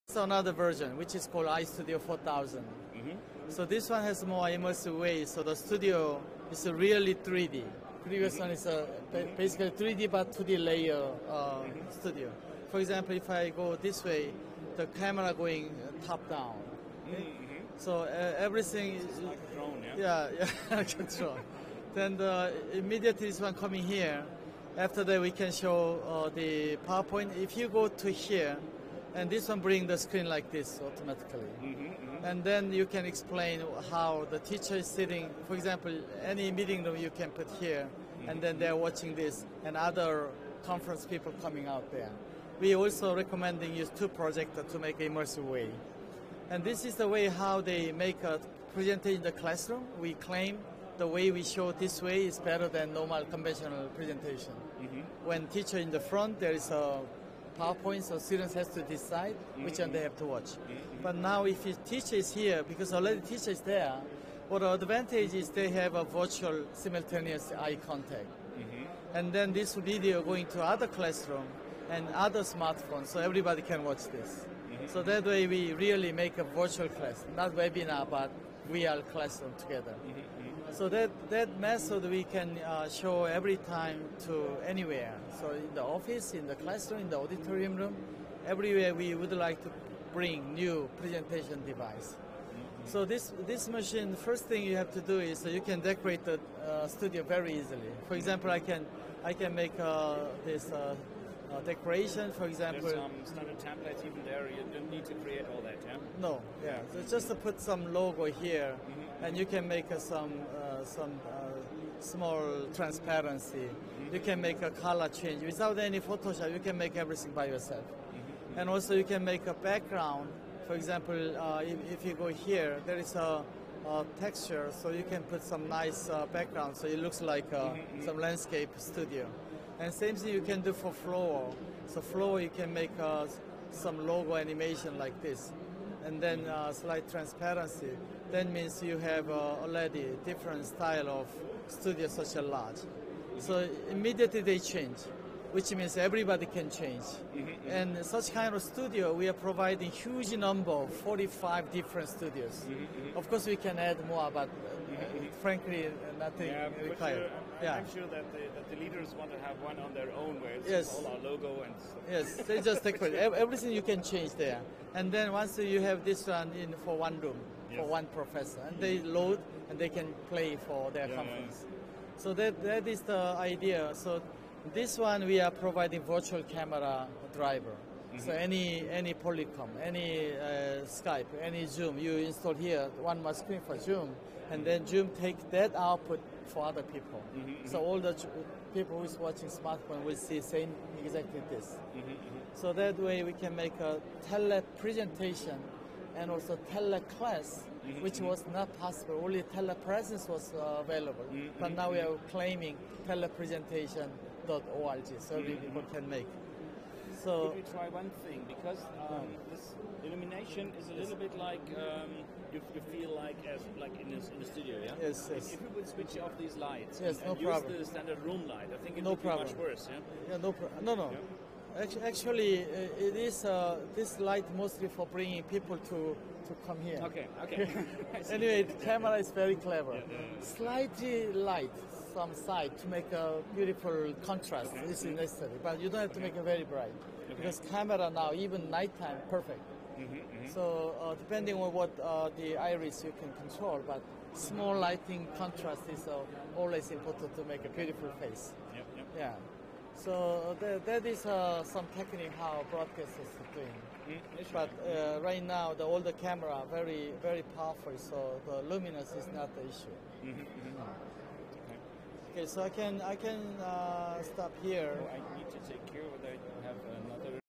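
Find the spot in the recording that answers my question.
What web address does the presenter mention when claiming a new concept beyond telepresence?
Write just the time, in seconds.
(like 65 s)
203 s.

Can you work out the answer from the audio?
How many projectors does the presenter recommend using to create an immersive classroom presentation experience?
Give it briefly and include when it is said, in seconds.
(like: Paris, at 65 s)
2, at 43 s.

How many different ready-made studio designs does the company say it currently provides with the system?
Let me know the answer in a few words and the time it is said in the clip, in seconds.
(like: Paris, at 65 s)
45, at 151 s.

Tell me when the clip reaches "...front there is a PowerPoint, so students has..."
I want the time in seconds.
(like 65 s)
55 s.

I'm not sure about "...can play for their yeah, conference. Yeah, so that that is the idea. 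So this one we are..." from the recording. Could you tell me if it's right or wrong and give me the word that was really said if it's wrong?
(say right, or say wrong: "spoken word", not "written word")
right.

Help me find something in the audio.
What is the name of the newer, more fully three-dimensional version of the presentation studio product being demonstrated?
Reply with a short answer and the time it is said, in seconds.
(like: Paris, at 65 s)
iStudio 4000, at 1 s.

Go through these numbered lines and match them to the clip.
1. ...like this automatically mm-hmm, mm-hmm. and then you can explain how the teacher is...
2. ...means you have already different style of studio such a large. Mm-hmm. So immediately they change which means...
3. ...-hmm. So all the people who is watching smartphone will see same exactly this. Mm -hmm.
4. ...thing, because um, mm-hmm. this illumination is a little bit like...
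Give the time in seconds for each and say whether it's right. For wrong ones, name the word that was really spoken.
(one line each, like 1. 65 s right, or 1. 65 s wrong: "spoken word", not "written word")
1. 30 s right
2. 138 s right
3. 187 s right
4. 208 s right.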